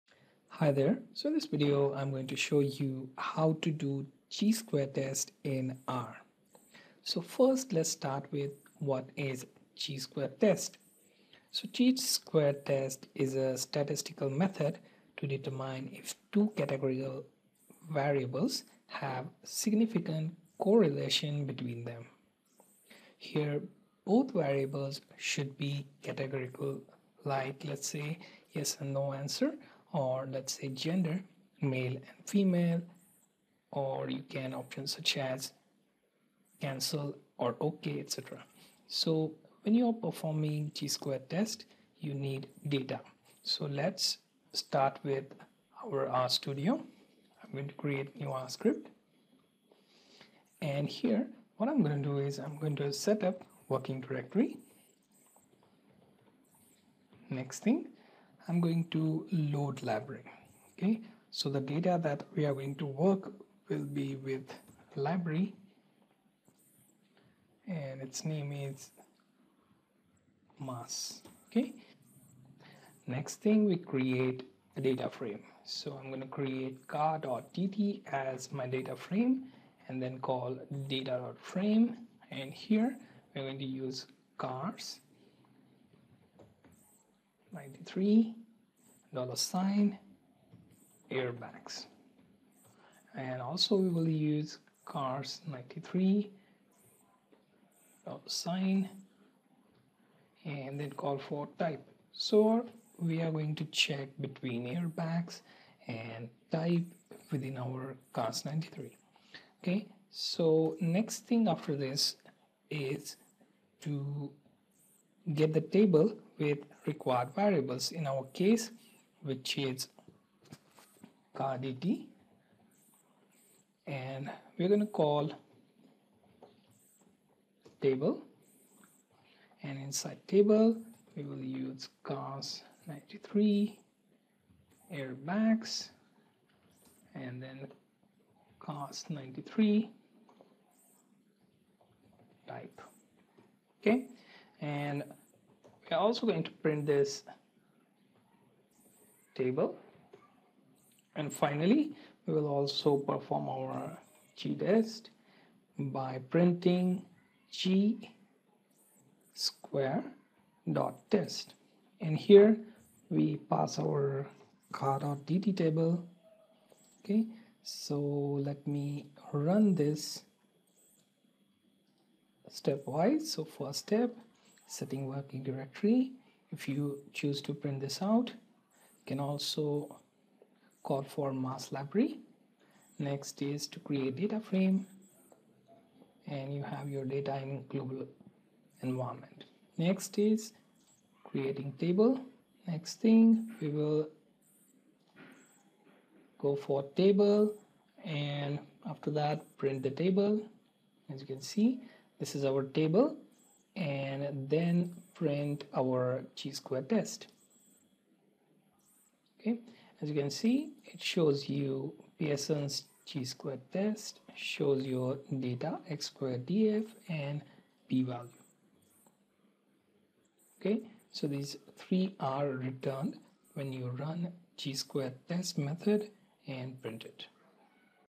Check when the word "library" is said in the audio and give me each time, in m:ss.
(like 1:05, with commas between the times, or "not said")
0:59, 1:04, 3:01.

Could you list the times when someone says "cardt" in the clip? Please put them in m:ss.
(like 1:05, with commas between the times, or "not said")
1:16, 2:44.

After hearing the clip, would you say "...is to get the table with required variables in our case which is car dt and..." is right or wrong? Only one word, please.
right.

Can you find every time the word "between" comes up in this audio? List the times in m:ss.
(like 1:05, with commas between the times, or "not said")
0:21, 1:44.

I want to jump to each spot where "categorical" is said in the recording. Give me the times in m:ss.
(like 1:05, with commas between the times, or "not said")
0:16, 0:26.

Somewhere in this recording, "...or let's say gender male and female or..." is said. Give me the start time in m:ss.
0:29.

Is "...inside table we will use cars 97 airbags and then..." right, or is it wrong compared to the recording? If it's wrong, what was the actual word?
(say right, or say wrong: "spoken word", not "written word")
wrong: "93", not "97".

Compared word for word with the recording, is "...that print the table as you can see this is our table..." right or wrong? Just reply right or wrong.
right.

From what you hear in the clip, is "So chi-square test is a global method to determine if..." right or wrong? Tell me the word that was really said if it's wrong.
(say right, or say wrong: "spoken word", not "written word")
wrong: "statistical", not "global".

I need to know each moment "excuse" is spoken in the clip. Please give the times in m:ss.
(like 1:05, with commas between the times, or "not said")
not said.